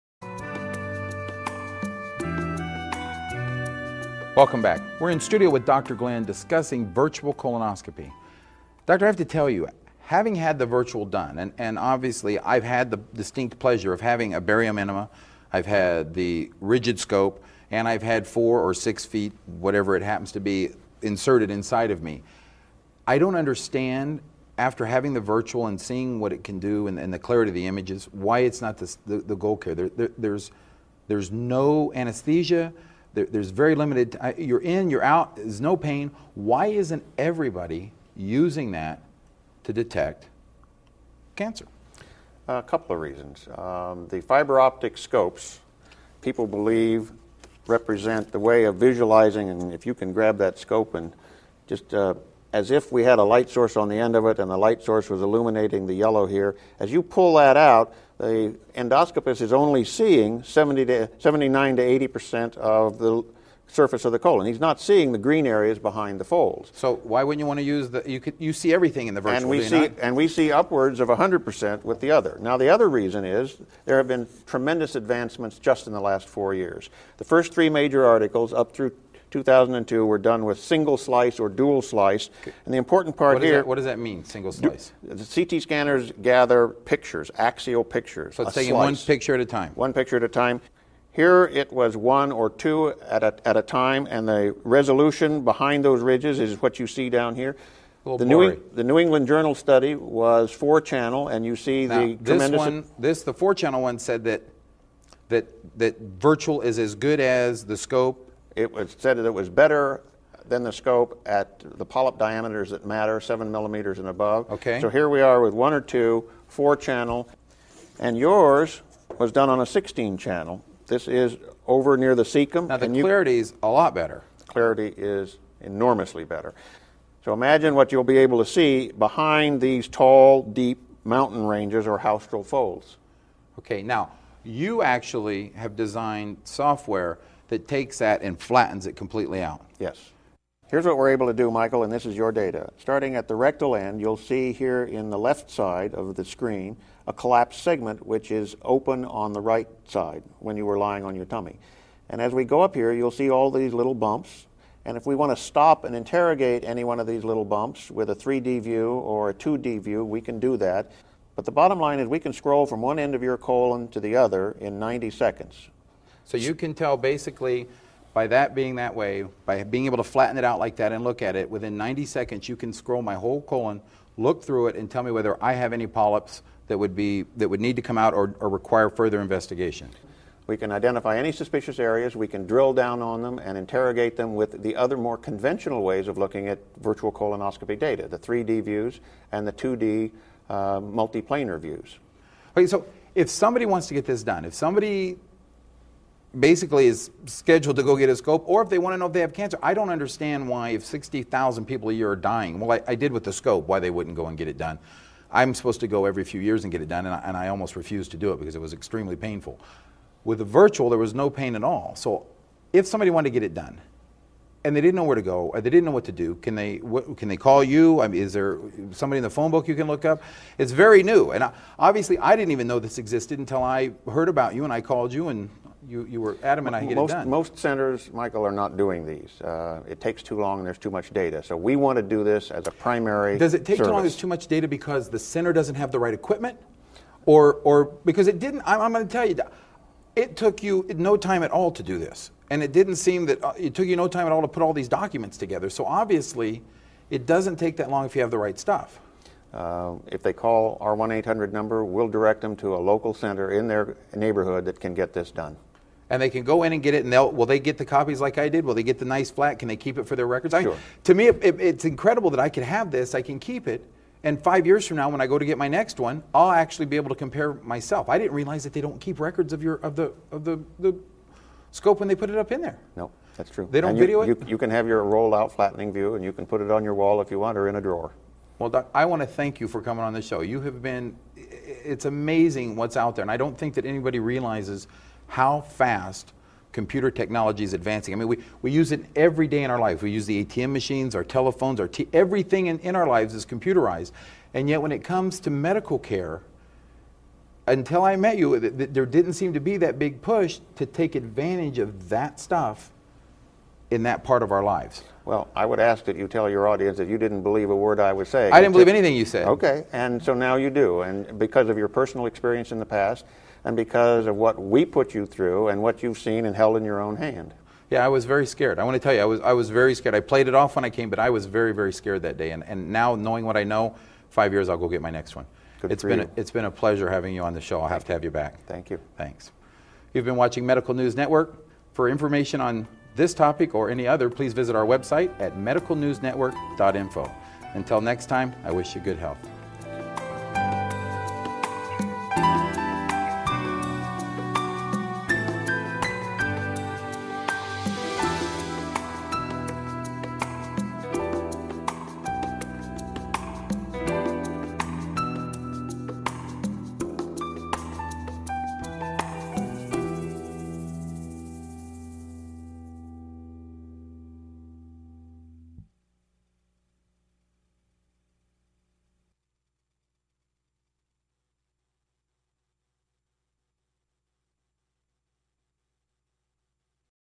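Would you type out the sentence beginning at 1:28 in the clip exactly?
So it's taking one picture at a time.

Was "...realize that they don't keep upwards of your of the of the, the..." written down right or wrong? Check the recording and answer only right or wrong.
wrong.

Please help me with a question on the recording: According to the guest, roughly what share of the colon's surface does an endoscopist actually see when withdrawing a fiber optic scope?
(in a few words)
79 to 80 percent.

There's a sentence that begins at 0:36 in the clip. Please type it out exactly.
Why isn't everybody using that to detect cancer?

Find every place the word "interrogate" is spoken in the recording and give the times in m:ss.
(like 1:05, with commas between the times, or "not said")
2:35, 3:03.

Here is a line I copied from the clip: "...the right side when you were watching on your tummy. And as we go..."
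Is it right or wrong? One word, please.
wrong.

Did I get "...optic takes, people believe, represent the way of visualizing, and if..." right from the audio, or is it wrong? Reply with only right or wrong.
wrong.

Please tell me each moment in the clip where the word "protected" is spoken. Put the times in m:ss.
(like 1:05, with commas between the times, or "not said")
not said.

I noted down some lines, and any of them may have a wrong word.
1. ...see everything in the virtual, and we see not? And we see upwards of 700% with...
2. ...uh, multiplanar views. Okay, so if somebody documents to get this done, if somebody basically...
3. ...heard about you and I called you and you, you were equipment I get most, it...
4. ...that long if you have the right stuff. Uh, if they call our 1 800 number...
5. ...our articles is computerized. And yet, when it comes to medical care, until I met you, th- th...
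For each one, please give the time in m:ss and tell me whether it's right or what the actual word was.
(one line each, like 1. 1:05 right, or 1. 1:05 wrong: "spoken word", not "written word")
1. 1:08 wrong: "100", not "700"
2. 3:10 wrong: "wants", not "documents"
3. 3:44 wrong: "adamant", not "equipment"
4. 4:07 right
5. 4:52 wrong: "lives", not "articles".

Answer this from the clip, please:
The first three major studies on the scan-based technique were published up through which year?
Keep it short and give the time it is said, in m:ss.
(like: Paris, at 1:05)
2002, at 1:19.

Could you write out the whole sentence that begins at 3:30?
With the virtual, there was no pain at all.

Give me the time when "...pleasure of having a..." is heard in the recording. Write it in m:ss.
0:13.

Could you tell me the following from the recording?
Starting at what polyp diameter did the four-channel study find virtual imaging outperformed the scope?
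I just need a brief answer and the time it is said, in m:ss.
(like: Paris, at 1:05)
7 millimeters, at 1:53.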